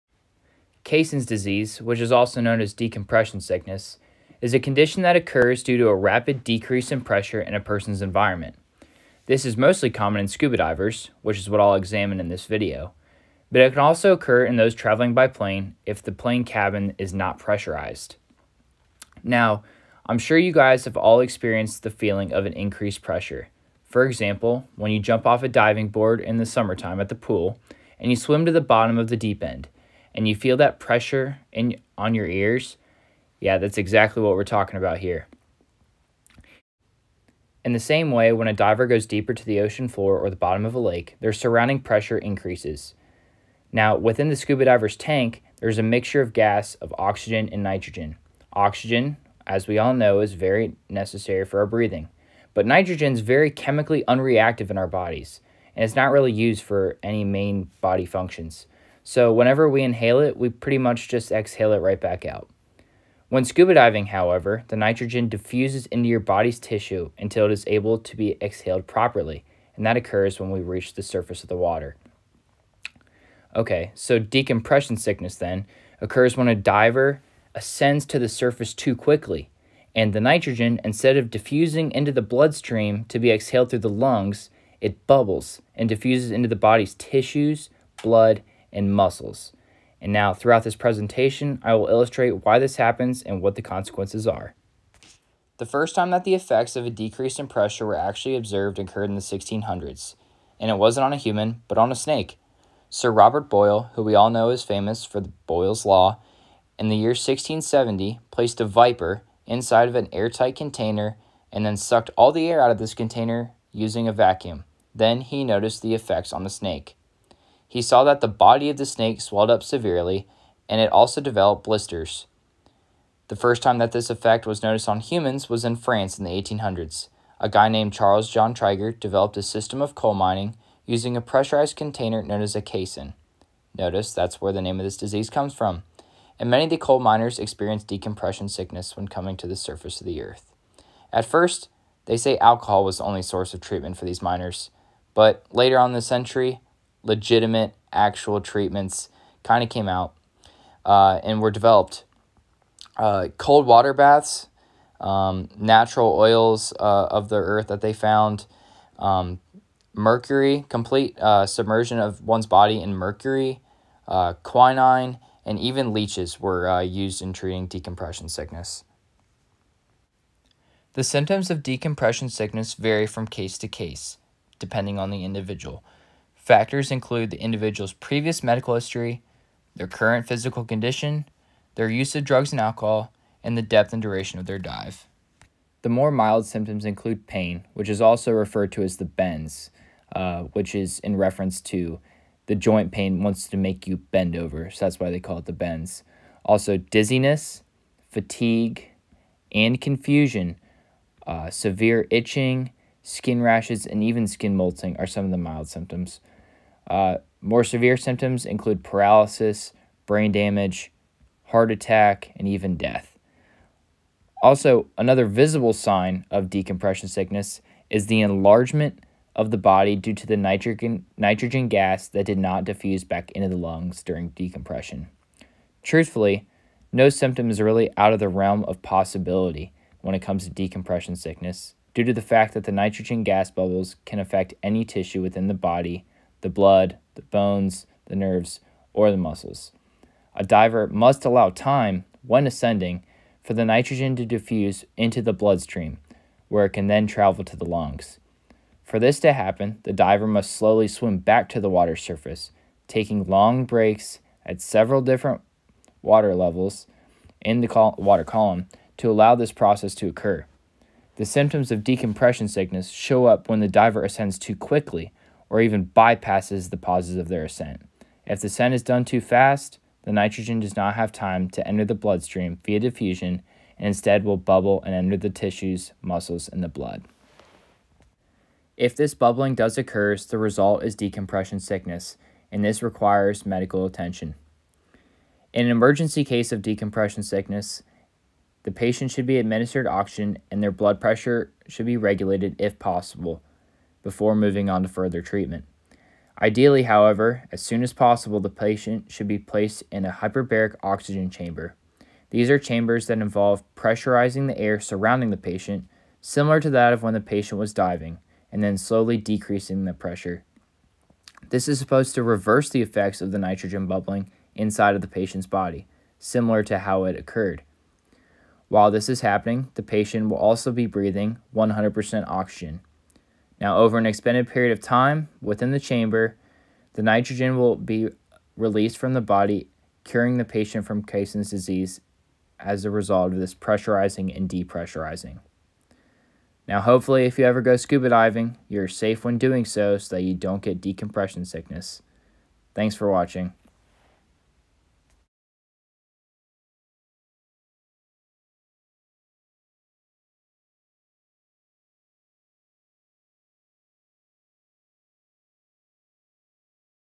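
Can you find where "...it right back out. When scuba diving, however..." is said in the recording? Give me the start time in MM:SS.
01:01.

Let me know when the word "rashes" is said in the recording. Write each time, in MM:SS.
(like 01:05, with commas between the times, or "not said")
03:23.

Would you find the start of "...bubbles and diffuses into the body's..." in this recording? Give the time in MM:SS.
01:25.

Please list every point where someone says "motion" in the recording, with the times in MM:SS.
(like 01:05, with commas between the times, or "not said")
not said.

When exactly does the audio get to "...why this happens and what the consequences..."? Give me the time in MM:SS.
01:32.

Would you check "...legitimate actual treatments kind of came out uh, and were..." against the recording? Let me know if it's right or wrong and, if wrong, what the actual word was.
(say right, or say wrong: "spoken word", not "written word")
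right.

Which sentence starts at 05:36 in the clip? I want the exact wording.
Now, hopefully, if you ever go scuba diving, you're safe when doing so so that you don't get decompression sickness.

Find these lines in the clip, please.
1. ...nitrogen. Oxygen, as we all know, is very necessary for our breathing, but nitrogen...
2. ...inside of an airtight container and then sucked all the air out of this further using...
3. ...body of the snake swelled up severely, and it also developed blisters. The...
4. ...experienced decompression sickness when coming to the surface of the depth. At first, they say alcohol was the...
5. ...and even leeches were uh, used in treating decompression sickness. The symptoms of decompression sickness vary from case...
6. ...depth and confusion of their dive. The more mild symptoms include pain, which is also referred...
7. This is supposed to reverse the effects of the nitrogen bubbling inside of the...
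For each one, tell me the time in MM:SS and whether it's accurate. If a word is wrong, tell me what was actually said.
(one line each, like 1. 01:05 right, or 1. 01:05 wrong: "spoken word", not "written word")
1. 00:47 right
2. 01:49 wrong: "container", not "further"
3. 01:58 right
4. 02:17 wrong: "earth", not "depth"
5. 02:45 right
6. 03:03 wrong: "duration", not "confusion"
7. 05:11 right.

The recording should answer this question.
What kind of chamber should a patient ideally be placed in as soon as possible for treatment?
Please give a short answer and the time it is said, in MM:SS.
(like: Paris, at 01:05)
Hyperbaric oxygen chamber, at 05:00.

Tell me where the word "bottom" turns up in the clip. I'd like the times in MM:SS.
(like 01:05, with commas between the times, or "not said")
00:28, 00:40.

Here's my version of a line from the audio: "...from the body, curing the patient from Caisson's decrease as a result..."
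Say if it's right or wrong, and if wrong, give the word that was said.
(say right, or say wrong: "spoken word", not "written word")
wrong: "disease", not "decrease".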